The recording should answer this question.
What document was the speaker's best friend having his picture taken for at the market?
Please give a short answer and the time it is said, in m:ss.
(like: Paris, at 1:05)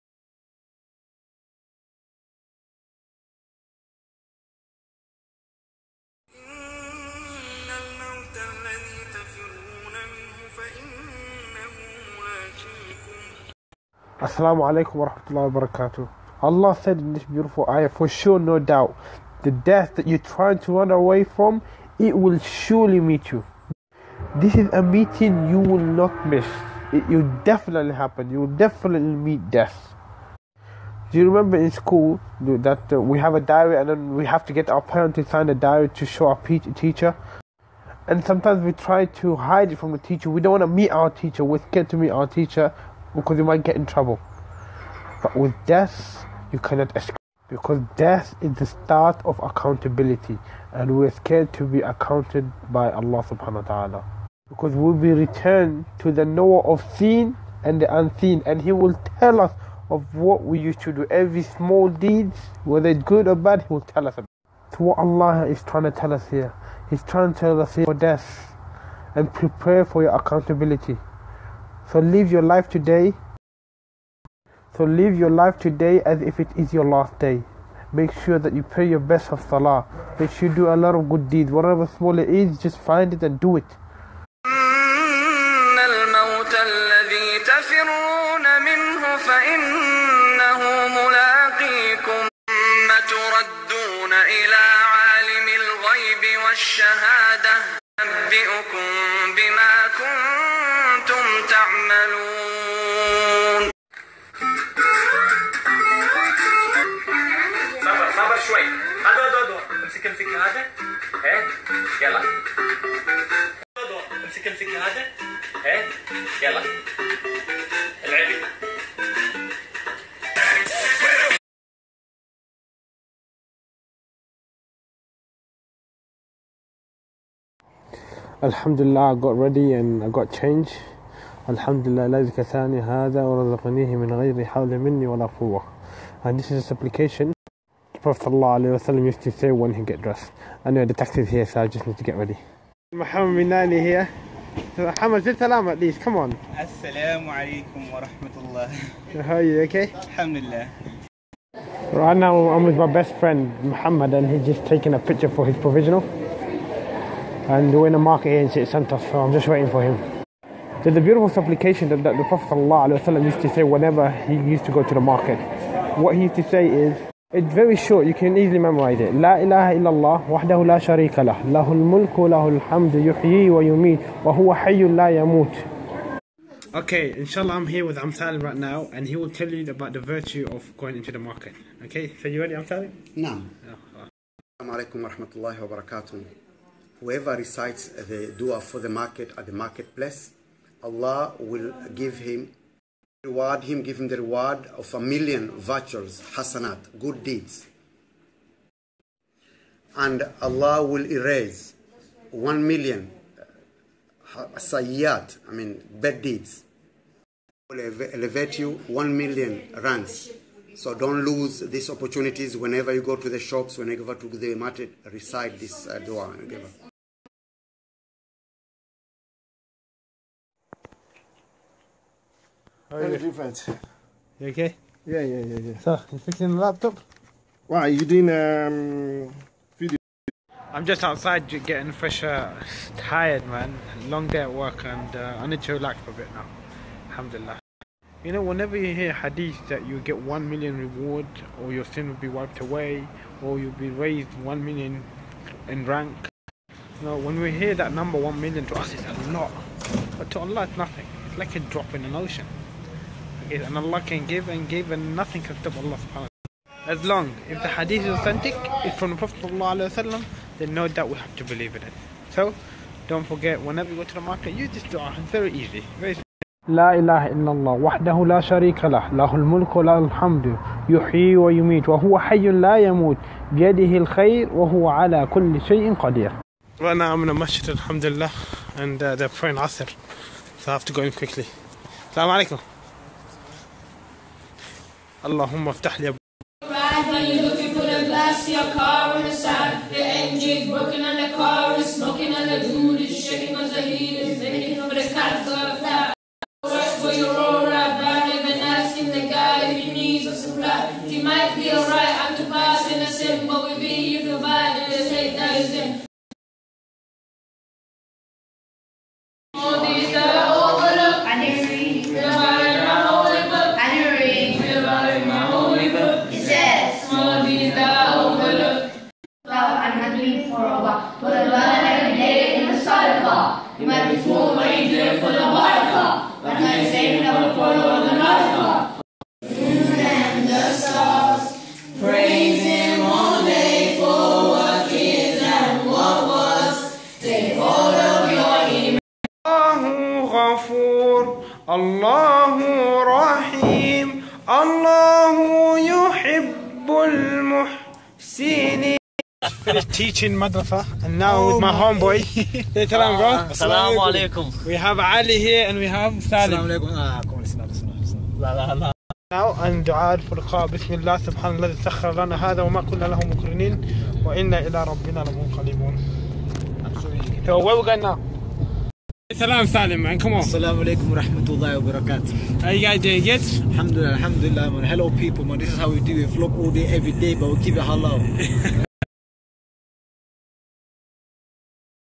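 his provisional, at 2:35.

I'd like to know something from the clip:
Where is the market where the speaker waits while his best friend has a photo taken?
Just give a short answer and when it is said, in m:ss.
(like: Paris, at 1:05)
City Centre, at 2:38.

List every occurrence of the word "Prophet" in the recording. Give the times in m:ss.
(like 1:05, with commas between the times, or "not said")
2:18, 2:42, 4:19.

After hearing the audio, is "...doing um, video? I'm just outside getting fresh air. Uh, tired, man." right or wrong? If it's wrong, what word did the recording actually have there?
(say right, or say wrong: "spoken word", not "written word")
right.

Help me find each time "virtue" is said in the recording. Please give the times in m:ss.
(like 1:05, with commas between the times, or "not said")
3:00, 3:15.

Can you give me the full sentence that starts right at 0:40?
We don't want to meet our teacher.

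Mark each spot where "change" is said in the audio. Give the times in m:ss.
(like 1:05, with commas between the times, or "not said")
2:10.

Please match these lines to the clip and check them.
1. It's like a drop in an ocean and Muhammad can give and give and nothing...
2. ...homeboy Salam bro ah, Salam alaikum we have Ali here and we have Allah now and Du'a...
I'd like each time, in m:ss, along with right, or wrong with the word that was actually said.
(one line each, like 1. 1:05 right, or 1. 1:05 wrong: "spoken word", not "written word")
1. 4:11 wrong: "Allah", not "Muhammad"
2. 5:51 wrong: "Salim", not "Allah".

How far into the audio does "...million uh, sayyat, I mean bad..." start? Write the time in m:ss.
3:22.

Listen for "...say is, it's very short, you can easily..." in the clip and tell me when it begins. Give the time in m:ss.
2:46.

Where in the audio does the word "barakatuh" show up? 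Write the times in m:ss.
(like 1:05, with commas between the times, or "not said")
0:15, 6:11.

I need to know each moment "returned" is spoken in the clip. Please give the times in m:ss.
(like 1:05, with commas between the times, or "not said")
0:55.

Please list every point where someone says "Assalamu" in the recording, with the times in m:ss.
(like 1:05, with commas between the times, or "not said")
0:14, 2:26, 4:42, 6:10.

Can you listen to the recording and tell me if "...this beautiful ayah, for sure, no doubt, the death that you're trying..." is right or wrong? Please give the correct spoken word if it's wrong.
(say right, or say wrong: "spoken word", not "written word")
right.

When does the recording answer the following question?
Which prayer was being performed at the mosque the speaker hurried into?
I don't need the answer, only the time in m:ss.
4:39.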